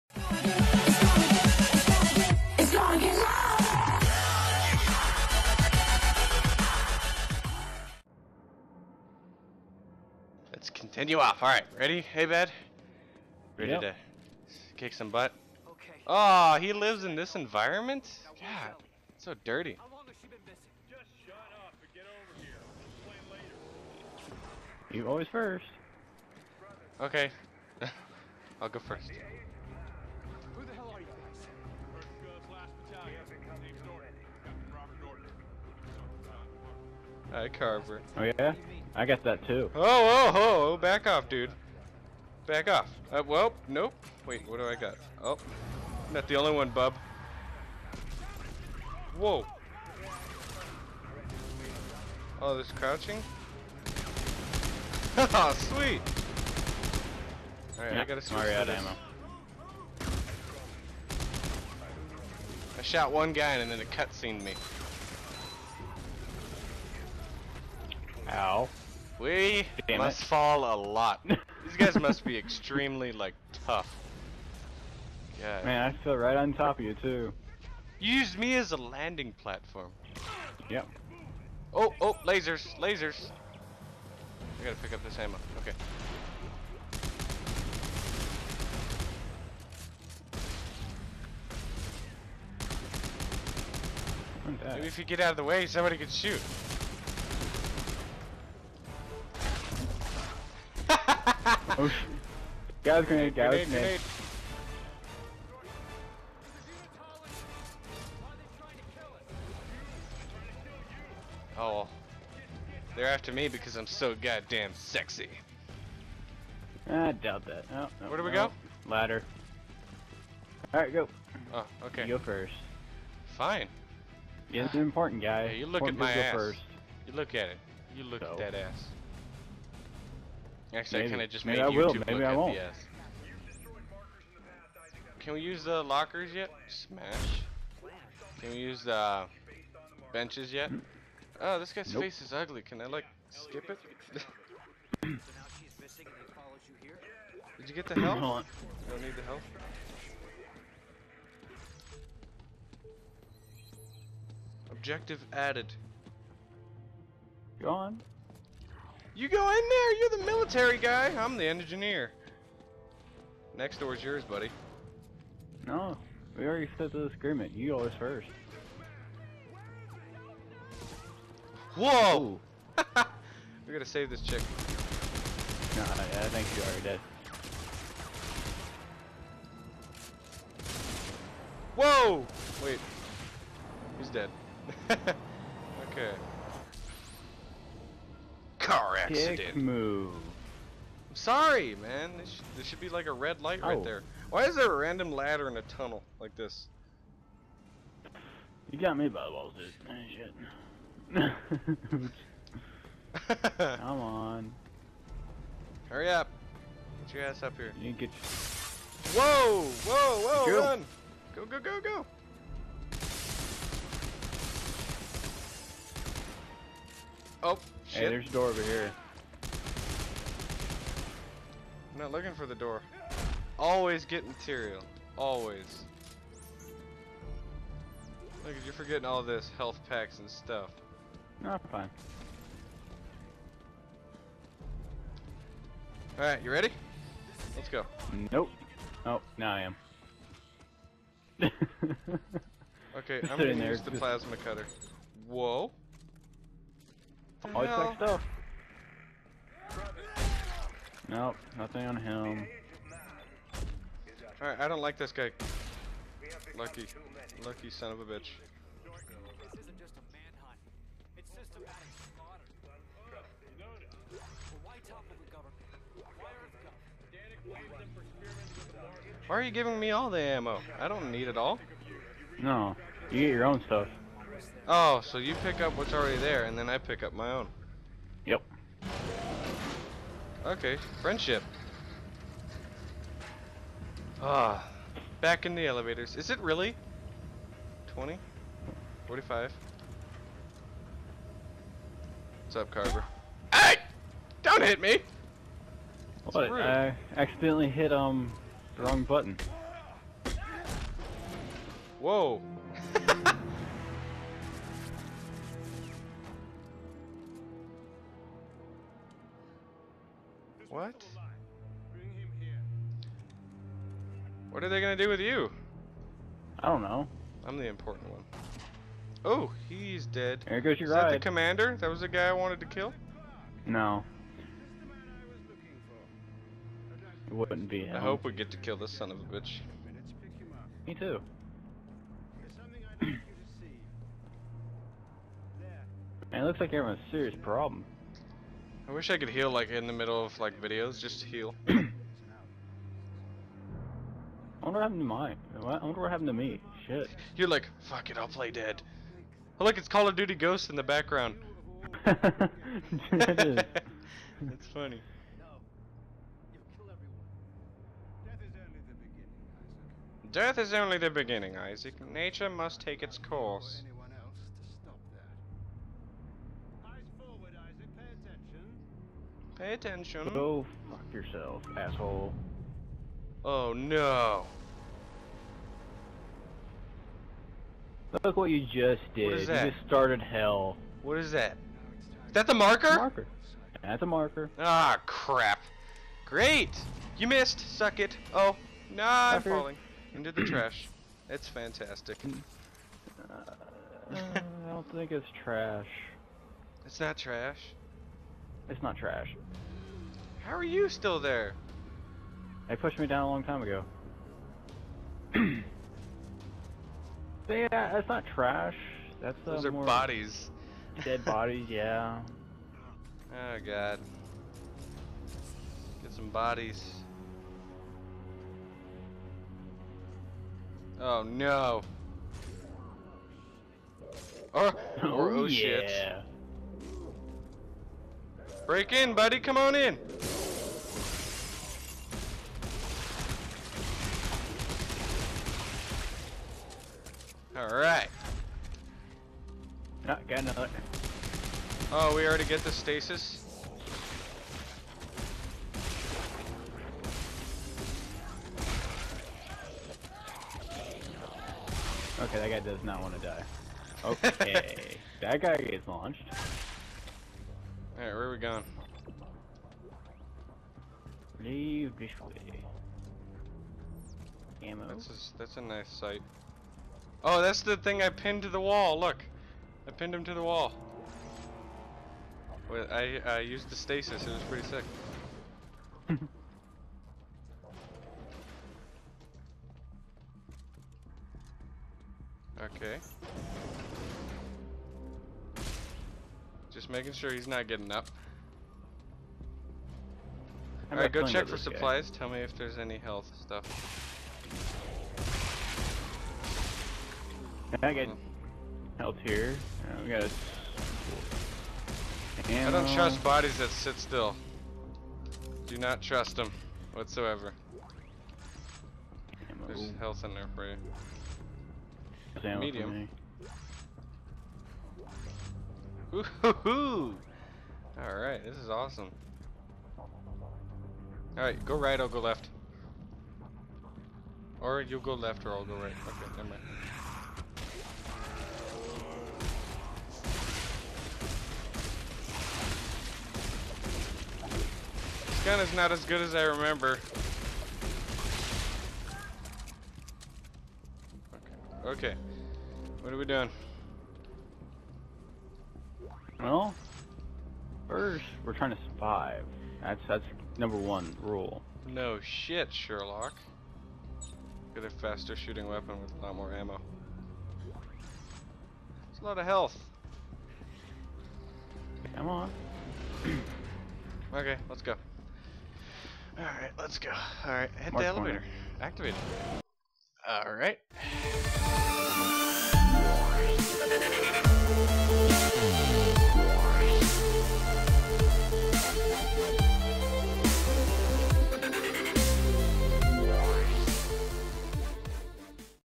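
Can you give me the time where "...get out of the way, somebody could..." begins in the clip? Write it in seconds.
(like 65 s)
95 s.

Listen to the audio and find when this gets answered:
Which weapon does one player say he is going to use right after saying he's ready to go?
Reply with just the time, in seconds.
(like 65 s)
243 s.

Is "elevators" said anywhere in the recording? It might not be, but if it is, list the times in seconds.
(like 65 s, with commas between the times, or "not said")
285 s, 568 s.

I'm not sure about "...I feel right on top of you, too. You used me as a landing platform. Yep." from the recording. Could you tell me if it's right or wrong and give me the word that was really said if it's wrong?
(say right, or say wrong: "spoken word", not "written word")
right.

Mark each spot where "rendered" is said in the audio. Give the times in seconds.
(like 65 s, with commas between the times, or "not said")
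not said.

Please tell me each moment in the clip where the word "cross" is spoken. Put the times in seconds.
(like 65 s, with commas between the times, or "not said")
not said.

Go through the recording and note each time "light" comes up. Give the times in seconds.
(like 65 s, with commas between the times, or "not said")
193 s.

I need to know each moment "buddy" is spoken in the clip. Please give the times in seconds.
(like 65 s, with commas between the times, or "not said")
164 s, 429 s.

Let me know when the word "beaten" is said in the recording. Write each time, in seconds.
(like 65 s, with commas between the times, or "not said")
not said.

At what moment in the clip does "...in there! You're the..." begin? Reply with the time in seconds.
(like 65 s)
159 s.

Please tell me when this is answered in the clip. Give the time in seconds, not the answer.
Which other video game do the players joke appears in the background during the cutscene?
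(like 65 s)
349 s.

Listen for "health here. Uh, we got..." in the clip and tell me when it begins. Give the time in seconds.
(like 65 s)
498 s.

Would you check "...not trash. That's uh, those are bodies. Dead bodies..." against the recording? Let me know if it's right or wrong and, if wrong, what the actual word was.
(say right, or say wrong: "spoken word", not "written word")
right.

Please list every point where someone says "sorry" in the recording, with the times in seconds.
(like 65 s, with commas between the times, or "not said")
191 s.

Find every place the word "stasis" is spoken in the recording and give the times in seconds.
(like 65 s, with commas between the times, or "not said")
442 s, 473 s.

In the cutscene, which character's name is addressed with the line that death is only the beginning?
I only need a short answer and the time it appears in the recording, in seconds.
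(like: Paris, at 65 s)
Isaac, at 361 s.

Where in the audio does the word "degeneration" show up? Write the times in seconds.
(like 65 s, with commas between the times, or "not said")
not said.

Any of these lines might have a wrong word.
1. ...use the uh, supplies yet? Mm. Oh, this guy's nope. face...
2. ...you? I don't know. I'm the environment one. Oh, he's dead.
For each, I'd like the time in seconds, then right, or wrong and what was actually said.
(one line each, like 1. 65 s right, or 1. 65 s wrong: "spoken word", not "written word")
1. 138 s wrong: "benches", not "supplies"
2. 315 s wrong: "important", not "environment".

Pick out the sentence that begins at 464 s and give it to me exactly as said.
That's a, that's a nice sight.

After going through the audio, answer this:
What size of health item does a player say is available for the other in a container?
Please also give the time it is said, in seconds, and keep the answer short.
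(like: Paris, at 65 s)
Medium, at 512 s.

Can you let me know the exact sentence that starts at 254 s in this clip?
Alright, I don't like this guy.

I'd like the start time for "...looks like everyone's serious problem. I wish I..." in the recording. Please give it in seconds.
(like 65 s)
336 s.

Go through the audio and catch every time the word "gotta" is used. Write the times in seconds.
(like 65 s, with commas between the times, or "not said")
58 s, 84 s, 173 s.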